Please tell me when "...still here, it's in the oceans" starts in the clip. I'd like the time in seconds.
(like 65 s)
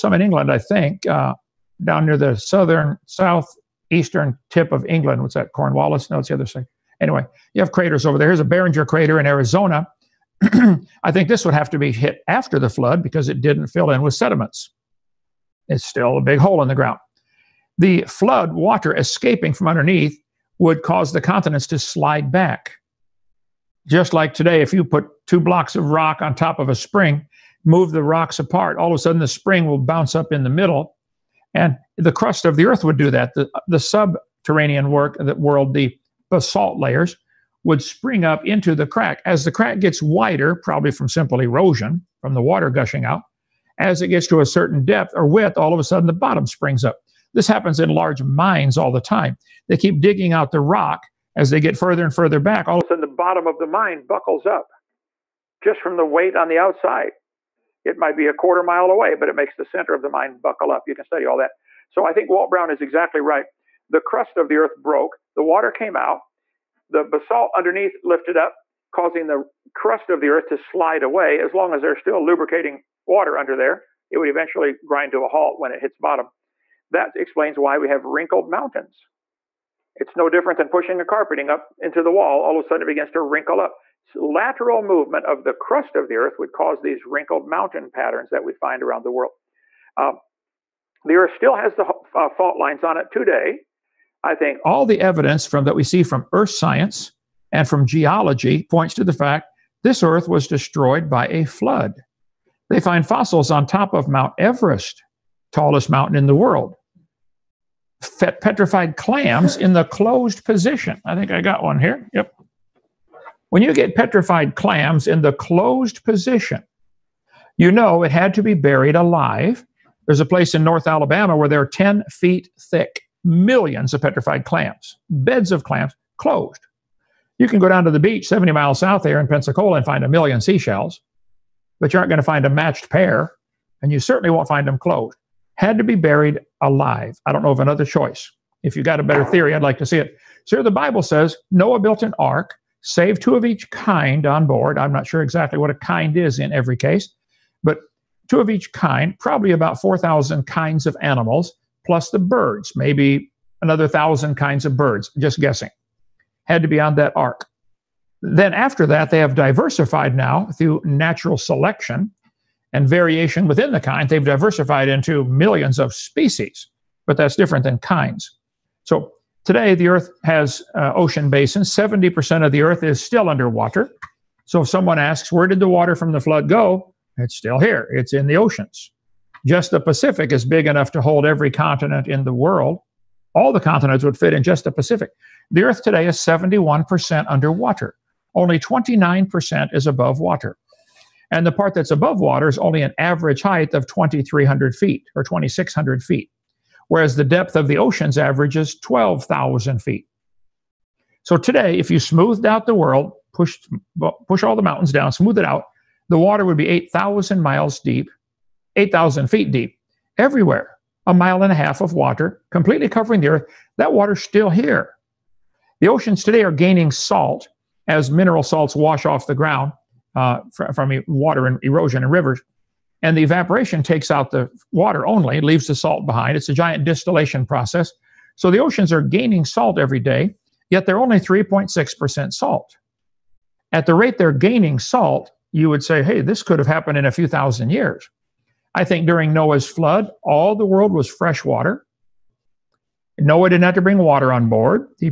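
177 s.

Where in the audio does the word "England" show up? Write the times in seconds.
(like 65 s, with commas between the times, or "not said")
0 s, 4 s.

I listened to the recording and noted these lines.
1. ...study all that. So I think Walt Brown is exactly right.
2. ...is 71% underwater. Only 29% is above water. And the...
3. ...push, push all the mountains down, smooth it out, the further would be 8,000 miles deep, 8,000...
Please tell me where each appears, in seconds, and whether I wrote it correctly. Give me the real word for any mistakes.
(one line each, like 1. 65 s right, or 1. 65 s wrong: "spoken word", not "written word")
1. 61 s right
2. 186 s right
3. 203 s wrong: "water", not "further".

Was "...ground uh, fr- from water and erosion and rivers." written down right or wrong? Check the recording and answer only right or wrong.
right.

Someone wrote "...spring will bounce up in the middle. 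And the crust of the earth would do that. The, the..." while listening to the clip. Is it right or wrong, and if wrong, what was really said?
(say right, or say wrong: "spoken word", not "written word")
right.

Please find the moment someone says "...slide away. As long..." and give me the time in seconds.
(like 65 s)
70 s.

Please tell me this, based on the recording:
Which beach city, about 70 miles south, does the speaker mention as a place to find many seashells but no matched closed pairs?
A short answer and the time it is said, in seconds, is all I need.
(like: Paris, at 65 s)
Pensacola, at 129 s.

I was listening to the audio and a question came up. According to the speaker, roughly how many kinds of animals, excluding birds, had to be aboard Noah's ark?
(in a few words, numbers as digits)
4,000.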